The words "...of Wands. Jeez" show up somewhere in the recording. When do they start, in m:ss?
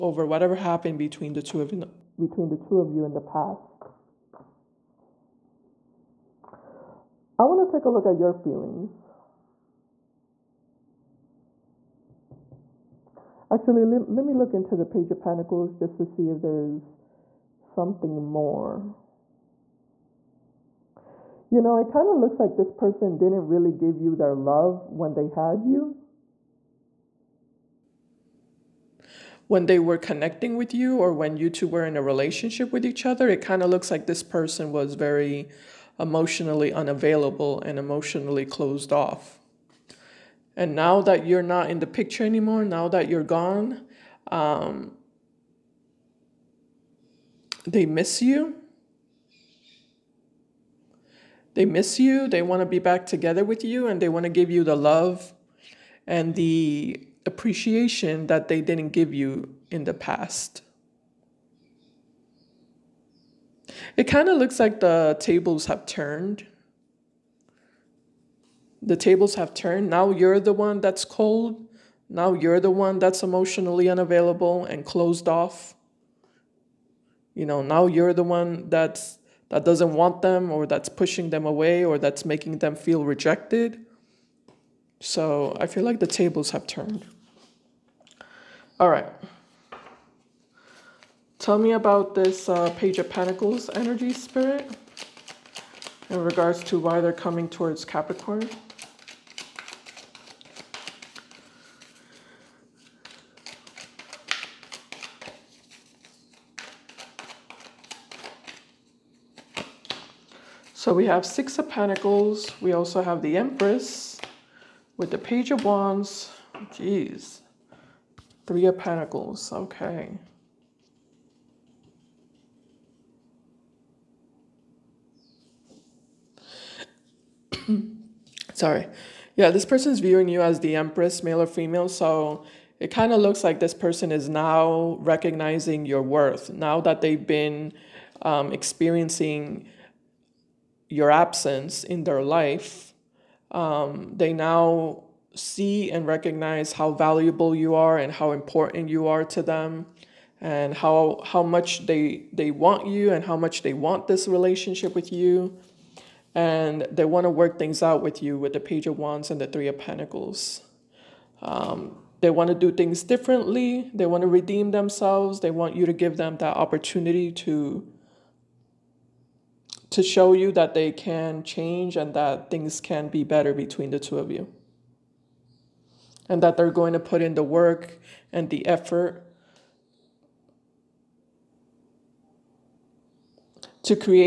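1:55.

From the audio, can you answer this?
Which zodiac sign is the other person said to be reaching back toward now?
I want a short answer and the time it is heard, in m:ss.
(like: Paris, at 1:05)
Capricorn, at 1:37.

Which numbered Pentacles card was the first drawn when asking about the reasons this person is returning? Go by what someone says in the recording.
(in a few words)
Six of Pentacles.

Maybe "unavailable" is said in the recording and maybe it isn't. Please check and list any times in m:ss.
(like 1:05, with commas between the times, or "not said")
0:36, 1:13.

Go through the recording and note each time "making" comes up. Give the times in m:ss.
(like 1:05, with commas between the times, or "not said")
1:22.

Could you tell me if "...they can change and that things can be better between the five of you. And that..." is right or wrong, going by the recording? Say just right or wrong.
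wrong.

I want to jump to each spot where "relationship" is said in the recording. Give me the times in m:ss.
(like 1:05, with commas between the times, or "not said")
0:32, 2:34.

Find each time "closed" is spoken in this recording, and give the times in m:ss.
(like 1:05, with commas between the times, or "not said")
0:38, 1:14.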